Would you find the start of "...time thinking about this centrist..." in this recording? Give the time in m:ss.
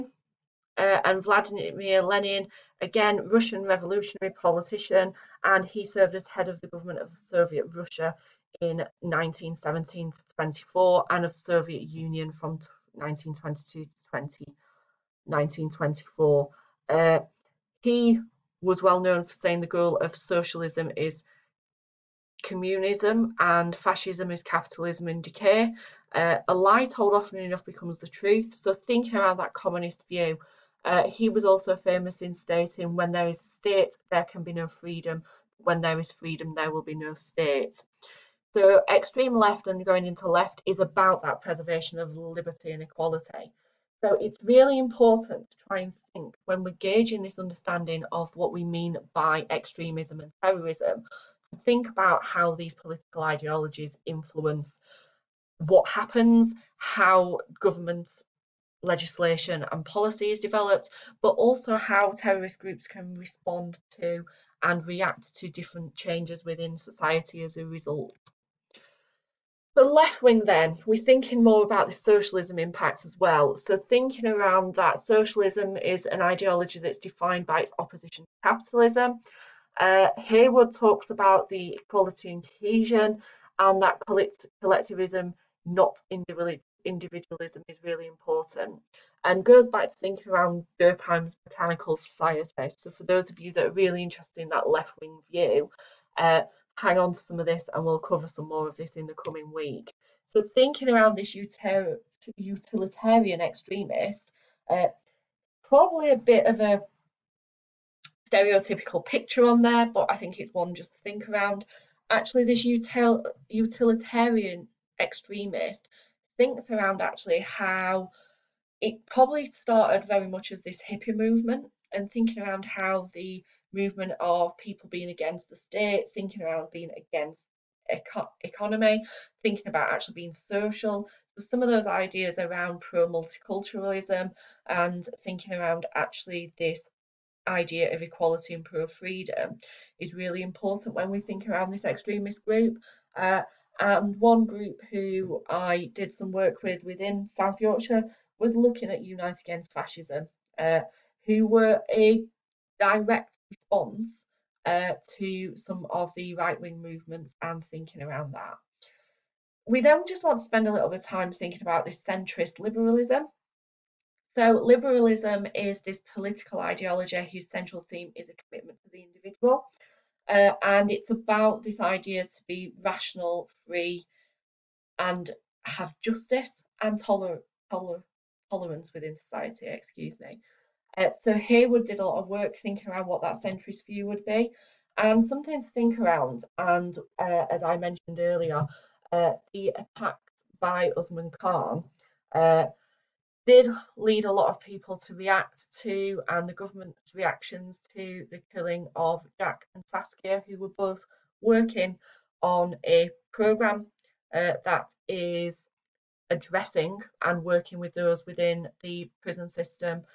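2:41.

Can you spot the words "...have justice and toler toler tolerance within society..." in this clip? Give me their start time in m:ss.
2:55.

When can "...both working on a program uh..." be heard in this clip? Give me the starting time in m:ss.
3:20.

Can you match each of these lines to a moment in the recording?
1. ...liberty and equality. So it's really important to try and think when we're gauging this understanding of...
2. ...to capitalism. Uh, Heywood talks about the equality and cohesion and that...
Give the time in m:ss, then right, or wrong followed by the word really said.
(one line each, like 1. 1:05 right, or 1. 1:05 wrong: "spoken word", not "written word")
1. 0:42 right
2. 1:18 right.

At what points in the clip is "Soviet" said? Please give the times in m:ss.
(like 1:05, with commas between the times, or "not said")
0:07, 0:11.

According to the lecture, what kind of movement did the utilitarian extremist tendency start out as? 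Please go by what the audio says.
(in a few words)
hippie movement.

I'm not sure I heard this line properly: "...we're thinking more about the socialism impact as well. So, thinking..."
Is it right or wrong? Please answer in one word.
right.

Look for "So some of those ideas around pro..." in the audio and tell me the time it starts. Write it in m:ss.
2:11.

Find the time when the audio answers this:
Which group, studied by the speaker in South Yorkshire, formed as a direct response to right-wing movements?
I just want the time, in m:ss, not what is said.
2:29.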